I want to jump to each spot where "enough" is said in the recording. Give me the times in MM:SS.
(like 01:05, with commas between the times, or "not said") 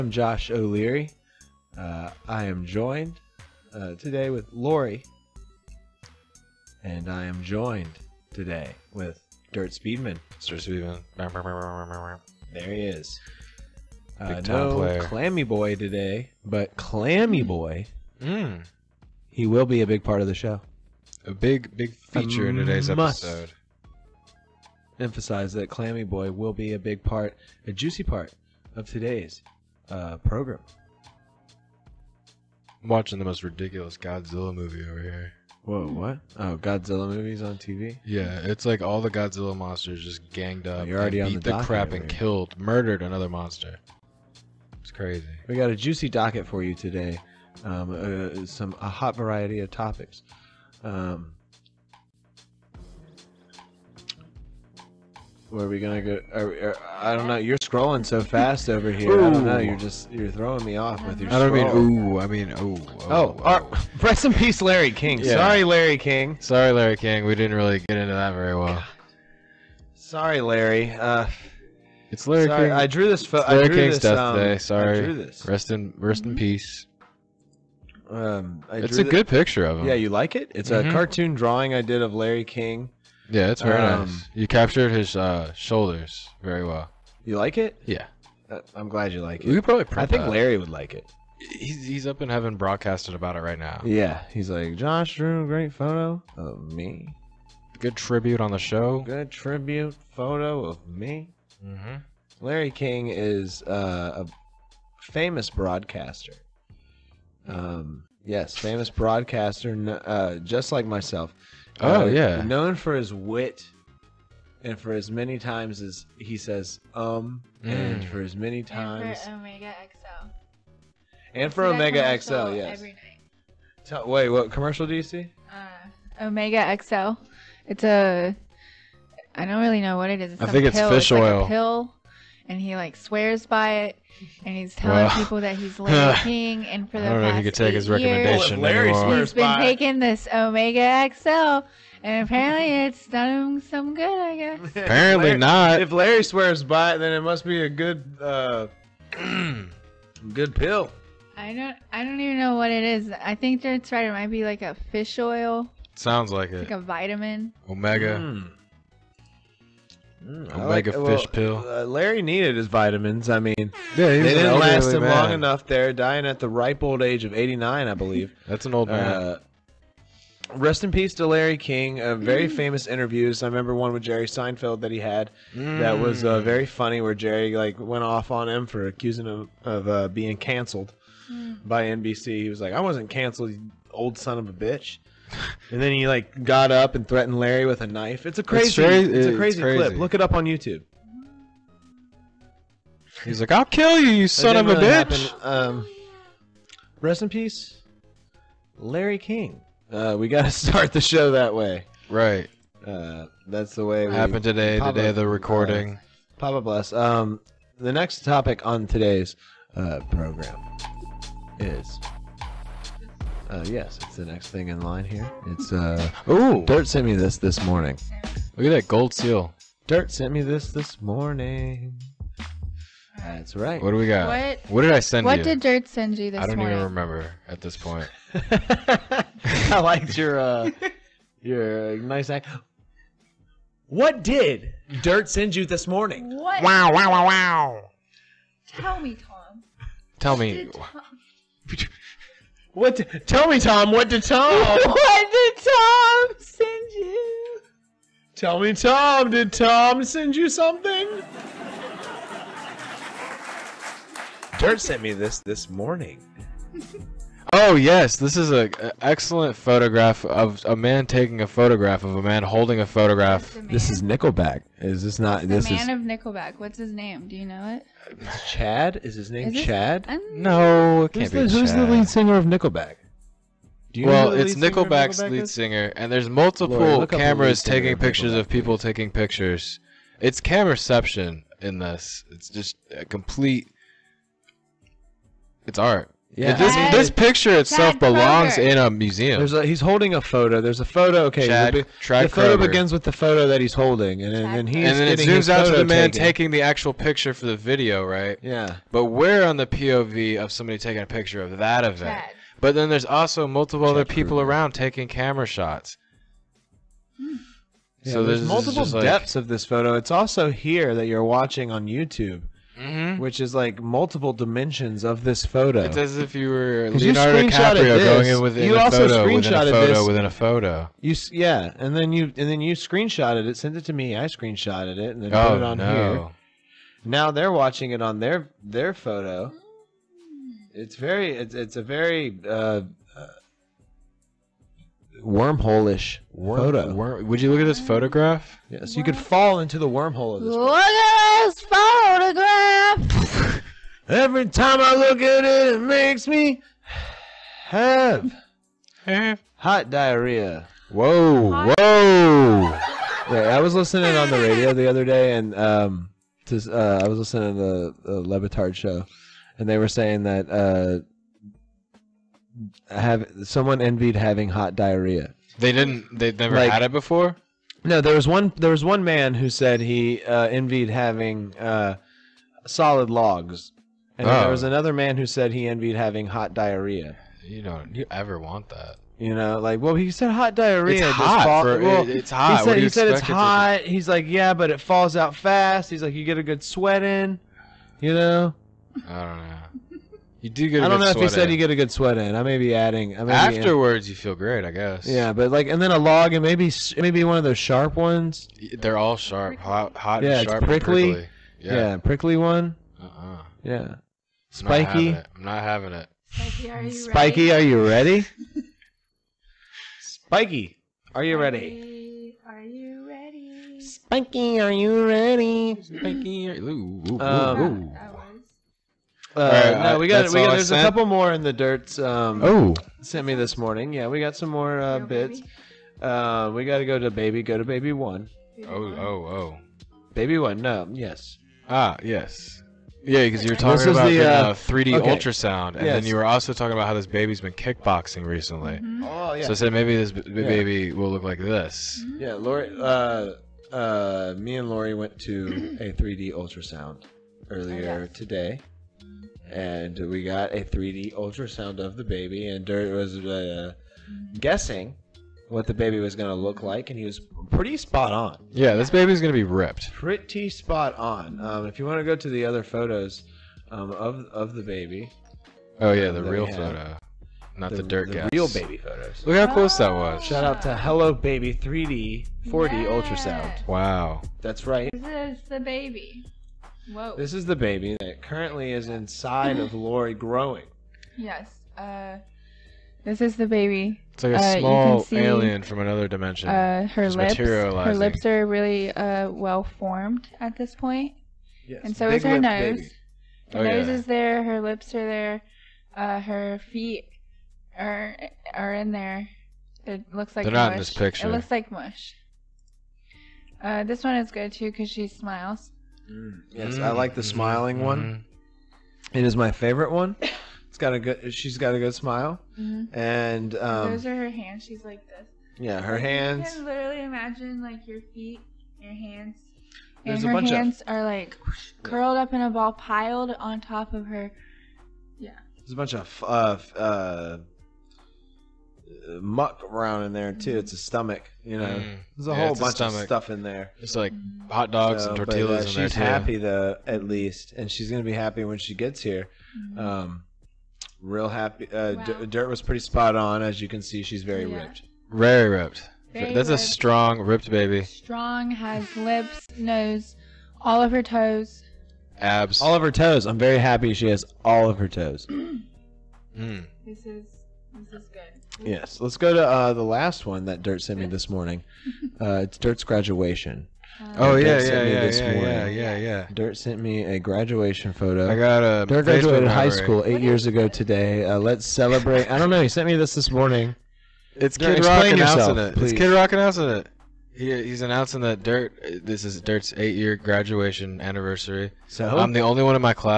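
02:45.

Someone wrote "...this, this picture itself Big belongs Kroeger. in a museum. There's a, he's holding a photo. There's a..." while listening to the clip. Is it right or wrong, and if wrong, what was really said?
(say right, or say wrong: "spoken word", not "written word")
wrong: "Chad", not "Big".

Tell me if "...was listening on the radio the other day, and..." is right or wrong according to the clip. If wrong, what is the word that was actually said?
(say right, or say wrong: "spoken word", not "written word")
right.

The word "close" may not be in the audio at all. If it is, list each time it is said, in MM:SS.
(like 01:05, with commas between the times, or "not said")
07:49.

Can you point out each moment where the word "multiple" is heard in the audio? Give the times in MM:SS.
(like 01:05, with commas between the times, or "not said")
04:36, 05:03, 05:08, 05:13.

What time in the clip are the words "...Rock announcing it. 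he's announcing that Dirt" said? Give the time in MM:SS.
09:36.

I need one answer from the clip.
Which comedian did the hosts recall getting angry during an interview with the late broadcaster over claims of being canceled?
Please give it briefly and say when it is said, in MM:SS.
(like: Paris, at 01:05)
Jerry Seinfeld, at 02:54.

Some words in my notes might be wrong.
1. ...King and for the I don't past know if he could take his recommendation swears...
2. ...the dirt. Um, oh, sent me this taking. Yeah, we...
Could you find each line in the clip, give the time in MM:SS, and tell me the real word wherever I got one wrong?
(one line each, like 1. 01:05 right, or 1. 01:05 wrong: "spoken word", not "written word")
1. 02:16 wrong: "years", not "swears"
2. 07:01 wrong: "morning", not "taking".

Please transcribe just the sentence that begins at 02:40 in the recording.
Mm, Omega like, fish well, pill.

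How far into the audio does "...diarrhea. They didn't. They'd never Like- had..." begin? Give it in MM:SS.
06:04.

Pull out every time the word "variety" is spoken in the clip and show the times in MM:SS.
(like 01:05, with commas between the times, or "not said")
00:49.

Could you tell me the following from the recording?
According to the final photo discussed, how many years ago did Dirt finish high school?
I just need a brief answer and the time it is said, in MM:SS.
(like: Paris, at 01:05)
8, at 09:30.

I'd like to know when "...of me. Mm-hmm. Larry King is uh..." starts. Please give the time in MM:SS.
01:40.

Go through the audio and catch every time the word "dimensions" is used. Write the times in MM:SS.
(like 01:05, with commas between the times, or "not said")
05:14, 08:06.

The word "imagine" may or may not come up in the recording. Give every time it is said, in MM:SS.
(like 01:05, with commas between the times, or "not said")
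08:37.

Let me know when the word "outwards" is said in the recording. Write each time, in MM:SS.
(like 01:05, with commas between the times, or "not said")
not said.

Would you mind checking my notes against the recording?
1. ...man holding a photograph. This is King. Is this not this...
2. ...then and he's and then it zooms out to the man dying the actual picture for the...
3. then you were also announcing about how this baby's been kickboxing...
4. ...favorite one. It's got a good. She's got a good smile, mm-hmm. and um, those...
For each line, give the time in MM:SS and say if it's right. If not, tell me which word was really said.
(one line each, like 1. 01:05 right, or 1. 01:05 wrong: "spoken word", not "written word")
1. 04:22 wrong: "Nickelback", not "King"
2. 04:54 wrong: "taking", not "dying"
3. 07:16 wrong: "talking", not "announcing"
4. 08:29 right.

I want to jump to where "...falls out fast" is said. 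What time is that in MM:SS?
06:24.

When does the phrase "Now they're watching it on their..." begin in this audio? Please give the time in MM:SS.
05:27.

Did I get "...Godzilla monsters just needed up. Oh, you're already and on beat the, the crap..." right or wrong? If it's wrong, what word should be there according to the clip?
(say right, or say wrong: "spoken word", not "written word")
wrong: "ganged", not "needed".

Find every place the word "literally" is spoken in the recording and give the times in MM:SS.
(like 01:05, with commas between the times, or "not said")
08:36.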